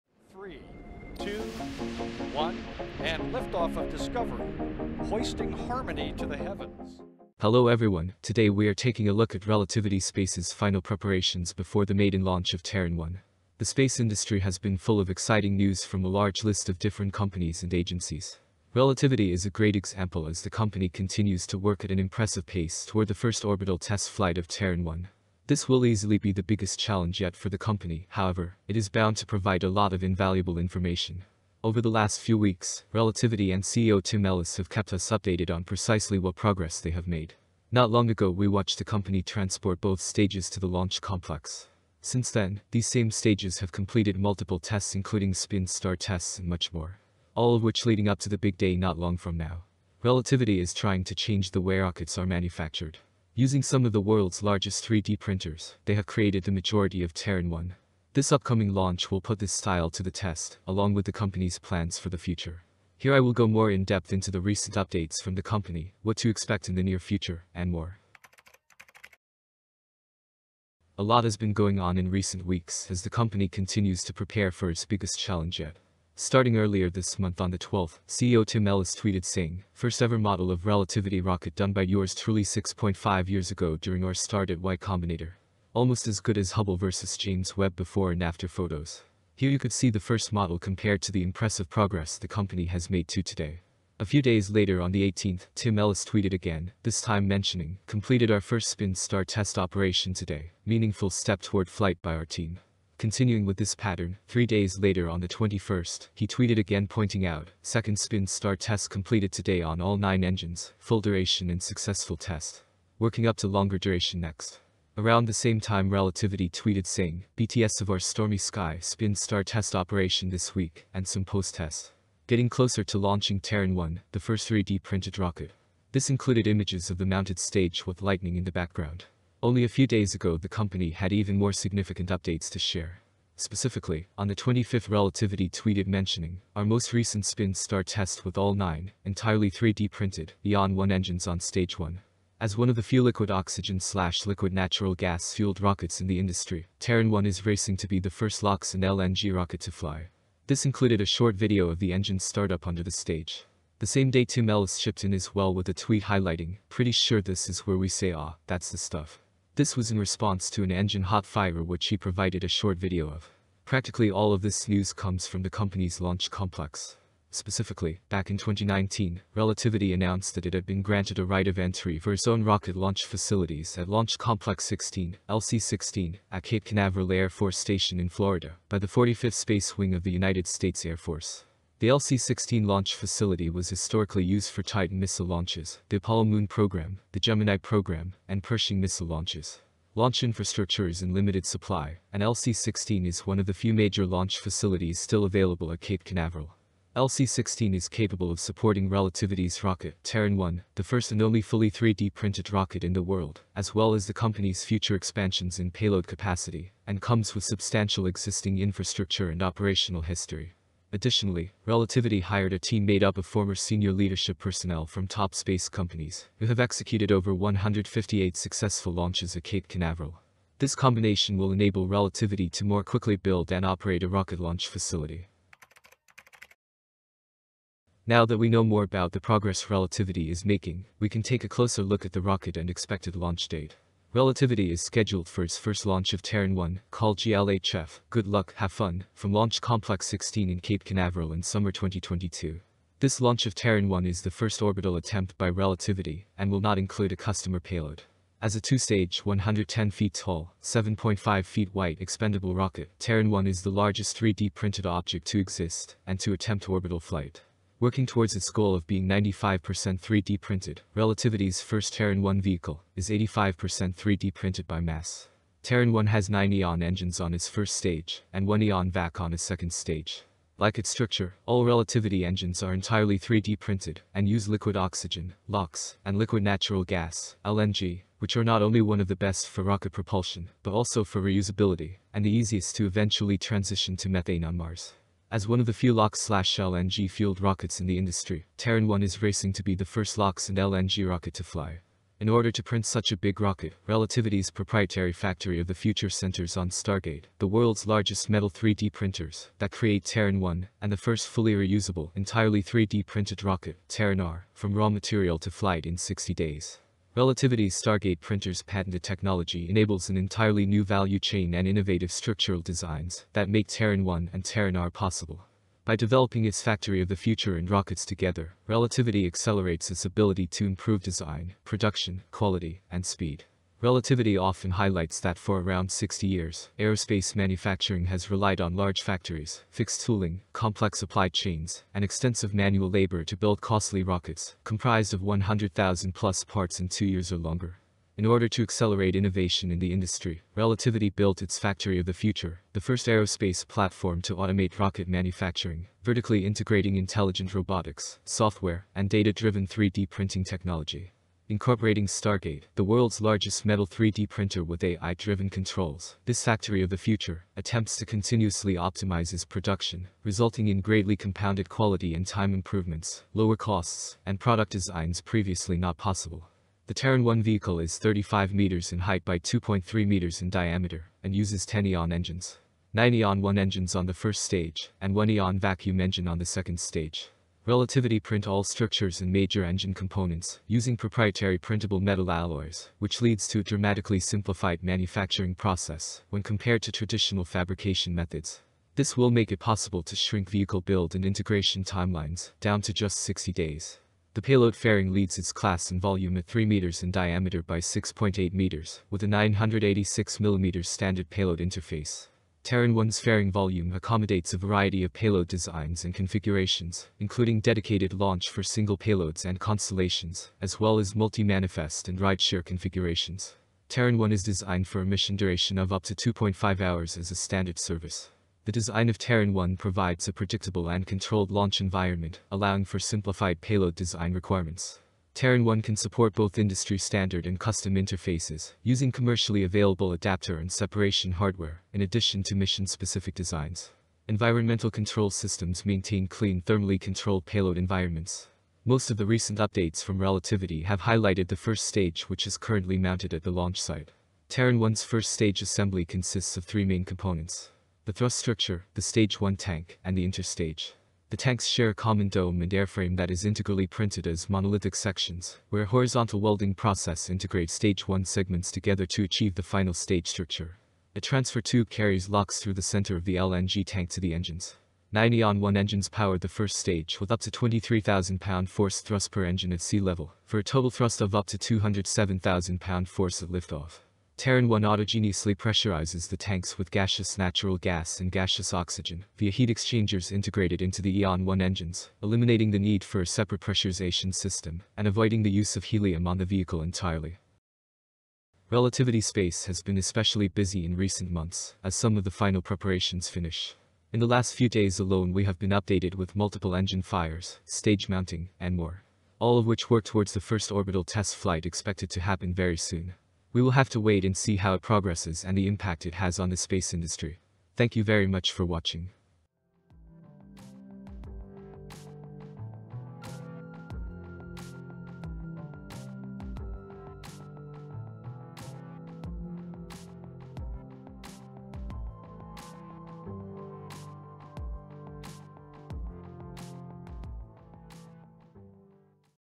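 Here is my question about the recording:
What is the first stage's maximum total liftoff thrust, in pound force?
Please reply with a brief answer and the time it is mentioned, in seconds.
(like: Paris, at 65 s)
207,000, at 471 s.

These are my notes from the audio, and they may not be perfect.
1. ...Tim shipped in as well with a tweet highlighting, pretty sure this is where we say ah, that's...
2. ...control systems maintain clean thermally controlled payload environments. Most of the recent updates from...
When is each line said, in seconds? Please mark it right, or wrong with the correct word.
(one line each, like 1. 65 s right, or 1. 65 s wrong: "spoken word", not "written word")
1. 154 s right
2. 434 s right.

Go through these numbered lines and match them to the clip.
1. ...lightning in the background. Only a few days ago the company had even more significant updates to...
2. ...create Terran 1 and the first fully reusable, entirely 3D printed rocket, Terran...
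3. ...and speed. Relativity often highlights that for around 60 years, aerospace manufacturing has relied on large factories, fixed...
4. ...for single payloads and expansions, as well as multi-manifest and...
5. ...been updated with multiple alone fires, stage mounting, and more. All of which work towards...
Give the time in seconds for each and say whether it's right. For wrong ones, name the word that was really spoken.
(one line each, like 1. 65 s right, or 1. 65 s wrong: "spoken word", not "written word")
1. 128 s right
2. 299 s right
3. 322 s right
4. 408 s wrong: "constellations", not "expansions"
5. 495 s wrong: "engine", not "alone".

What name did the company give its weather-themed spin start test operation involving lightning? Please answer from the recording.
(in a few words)
Stormy Sky.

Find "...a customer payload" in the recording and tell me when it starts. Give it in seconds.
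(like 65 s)
247 s.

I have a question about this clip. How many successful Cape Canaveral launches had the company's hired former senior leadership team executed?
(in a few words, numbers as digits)
158.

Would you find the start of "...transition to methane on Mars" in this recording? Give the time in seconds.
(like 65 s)
283 s.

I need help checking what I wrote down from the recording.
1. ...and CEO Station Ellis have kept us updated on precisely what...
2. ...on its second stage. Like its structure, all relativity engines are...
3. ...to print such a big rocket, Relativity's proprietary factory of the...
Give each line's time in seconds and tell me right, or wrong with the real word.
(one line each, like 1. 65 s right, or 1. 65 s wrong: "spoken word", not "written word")
1. 33 s wrong: "Tim", not "Station"
2. 269 s right
3. 292 s right.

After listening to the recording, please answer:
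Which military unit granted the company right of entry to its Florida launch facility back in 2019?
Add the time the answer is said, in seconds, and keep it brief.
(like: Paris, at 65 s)
45th Space Wing, at 178 s.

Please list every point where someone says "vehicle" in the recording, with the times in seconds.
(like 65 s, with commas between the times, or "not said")
262 s, 367 s, 390 s, 486 s.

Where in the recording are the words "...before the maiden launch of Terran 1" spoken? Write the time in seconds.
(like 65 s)
11 s.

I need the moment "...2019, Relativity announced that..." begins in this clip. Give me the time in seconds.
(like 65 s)
168 s.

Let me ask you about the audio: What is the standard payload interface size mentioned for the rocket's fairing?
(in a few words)
986 mm.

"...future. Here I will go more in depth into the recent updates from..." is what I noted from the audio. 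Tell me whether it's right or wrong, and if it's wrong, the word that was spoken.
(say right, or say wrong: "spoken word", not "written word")
right.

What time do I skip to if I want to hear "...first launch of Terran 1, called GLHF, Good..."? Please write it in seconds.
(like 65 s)
235 s.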